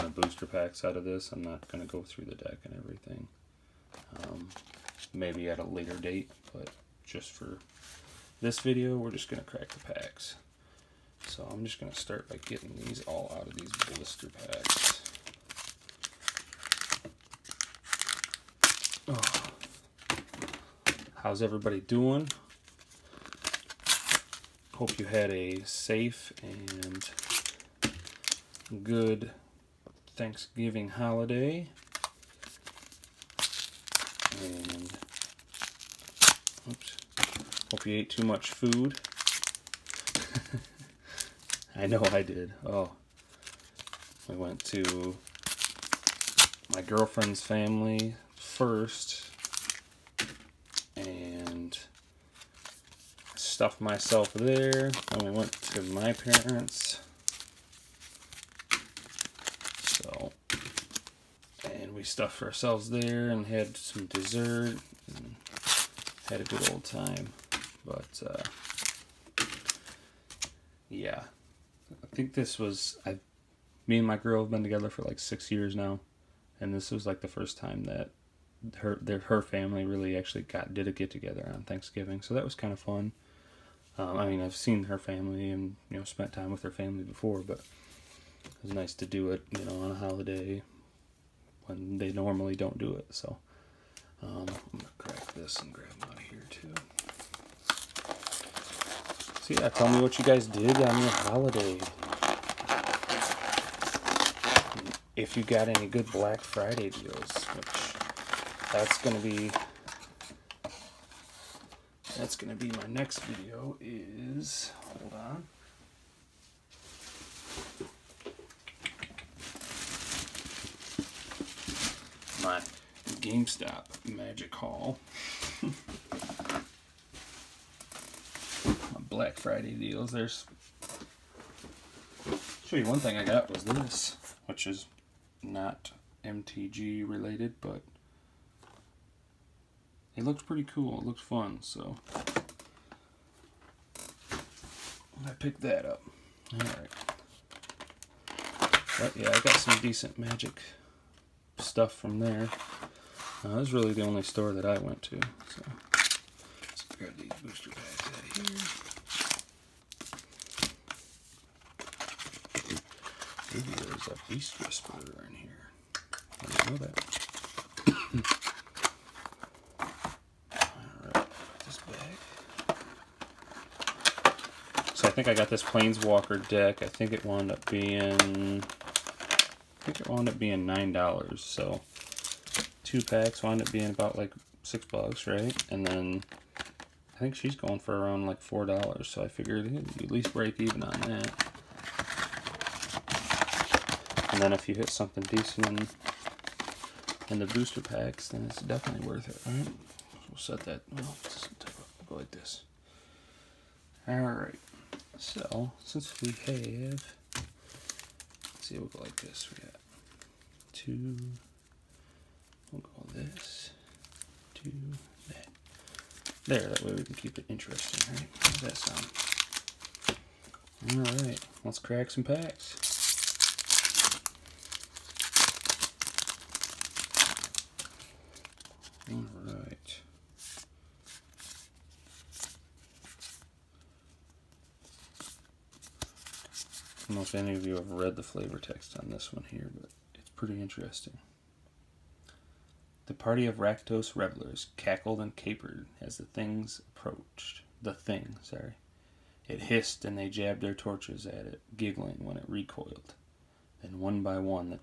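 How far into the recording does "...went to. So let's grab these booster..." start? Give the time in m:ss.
2:34.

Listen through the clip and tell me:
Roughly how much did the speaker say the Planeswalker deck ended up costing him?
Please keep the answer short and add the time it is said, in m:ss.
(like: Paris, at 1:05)
9 dollars, at 3:00.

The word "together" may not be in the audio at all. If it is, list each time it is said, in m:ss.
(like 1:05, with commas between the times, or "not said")
1:14, 1:21.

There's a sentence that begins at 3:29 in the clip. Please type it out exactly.
We got two, we'll go this, two, that.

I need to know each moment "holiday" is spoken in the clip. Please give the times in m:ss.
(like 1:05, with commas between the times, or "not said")
0:30, 1:29, 1:41.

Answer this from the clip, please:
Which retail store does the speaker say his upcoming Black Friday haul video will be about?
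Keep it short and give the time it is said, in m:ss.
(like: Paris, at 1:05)
GameStop, at 2:03.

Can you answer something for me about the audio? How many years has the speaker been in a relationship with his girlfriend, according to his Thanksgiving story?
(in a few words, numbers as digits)
6.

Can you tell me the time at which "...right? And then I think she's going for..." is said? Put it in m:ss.
3:05.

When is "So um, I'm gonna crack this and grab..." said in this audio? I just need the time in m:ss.
1:33.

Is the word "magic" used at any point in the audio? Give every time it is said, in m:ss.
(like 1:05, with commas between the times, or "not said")
2:04, 2:30.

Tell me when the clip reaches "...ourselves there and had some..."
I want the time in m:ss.
1:02.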